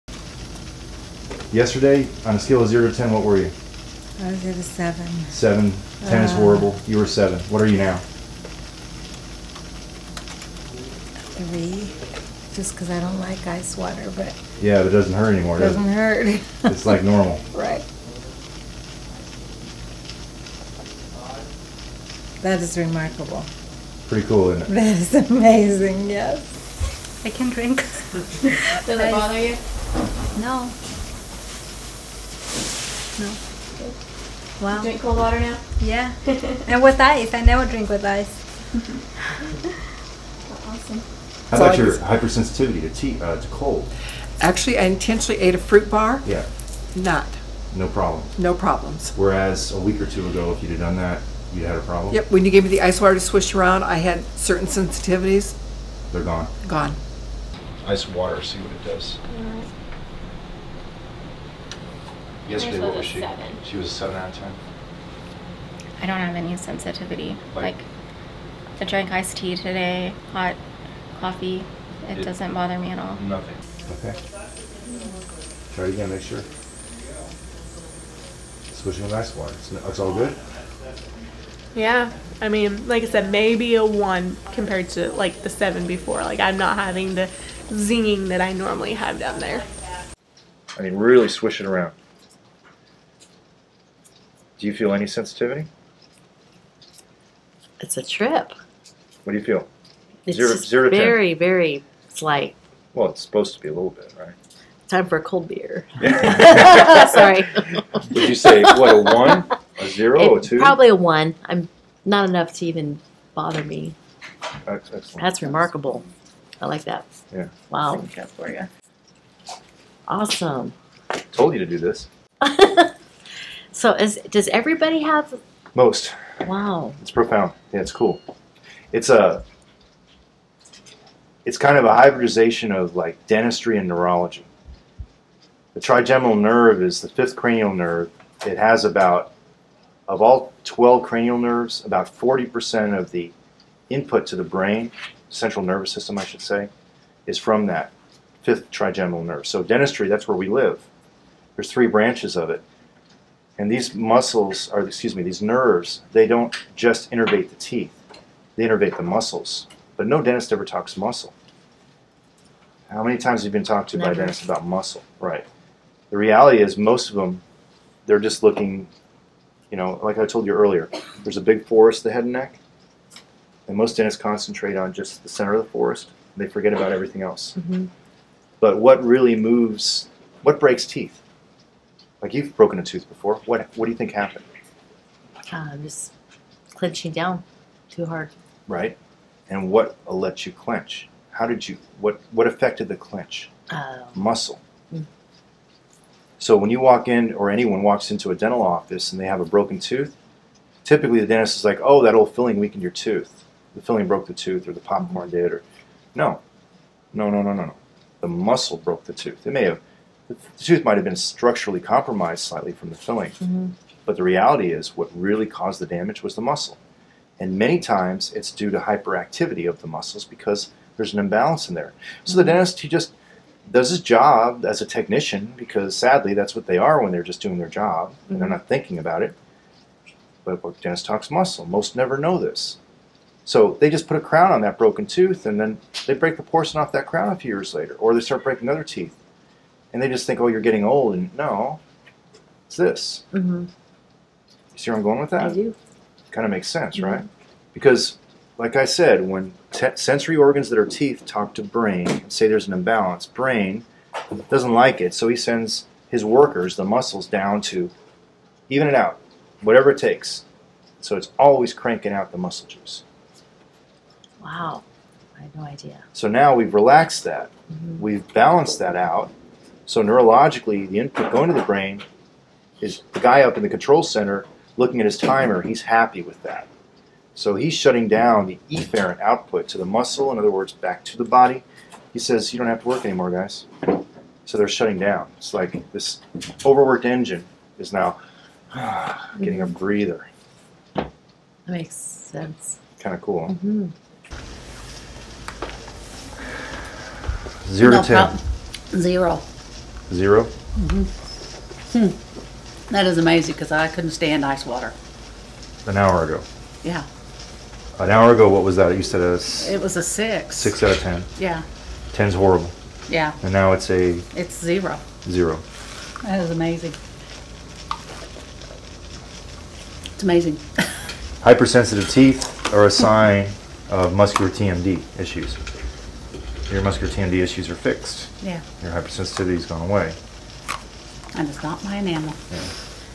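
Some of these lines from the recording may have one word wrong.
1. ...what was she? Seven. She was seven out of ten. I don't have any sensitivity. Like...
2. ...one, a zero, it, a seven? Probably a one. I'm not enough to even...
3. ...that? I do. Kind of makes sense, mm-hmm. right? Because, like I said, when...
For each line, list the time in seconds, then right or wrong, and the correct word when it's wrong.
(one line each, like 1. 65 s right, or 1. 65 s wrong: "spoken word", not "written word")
1. 62 s right
2. 109 s wrong: "two", not "seven"
3. 245 s right.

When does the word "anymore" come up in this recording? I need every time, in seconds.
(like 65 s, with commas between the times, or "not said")
15 s, 283 s.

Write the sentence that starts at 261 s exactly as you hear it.
So it's always cranking out the muscle juice.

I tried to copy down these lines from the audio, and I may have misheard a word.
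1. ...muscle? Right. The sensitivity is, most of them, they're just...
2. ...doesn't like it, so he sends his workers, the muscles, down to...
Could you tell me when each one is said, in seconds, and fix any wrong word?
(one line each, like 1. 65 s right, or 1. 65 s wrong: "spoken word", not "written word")
1. 164 s wrong: "reality", not "sensitivity"
2. 254 s right.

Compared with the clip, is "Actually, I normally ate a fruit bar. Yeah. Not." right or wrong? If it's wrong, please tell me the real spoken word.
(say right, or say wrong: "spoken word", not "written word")
wrong: "intentionally", not "normally".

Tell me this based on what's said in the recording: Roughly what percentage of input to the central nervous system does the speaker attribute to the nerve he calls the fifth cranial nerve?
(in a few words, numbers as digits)
40%.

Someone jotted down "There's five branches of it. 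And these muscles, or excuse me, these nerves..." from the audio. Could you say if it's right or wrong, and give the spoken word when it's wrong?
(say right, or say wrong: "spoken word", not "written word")
wrong: "three", not "five".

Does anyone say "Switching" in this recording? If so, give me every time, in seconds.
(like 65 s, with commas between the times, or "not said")
78 s.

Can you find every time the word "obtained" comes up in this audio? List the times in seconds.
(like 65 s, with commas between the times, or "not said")
not said.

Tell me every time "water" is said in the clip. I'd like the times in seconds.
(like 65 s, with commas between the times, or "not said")
13 s, 35 s, 52 s, 58 s, 79 s, 304 s.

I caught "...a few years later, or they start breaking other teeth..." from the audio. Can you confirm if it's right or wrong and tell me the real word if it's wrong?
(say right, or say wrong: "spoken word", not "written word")
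right.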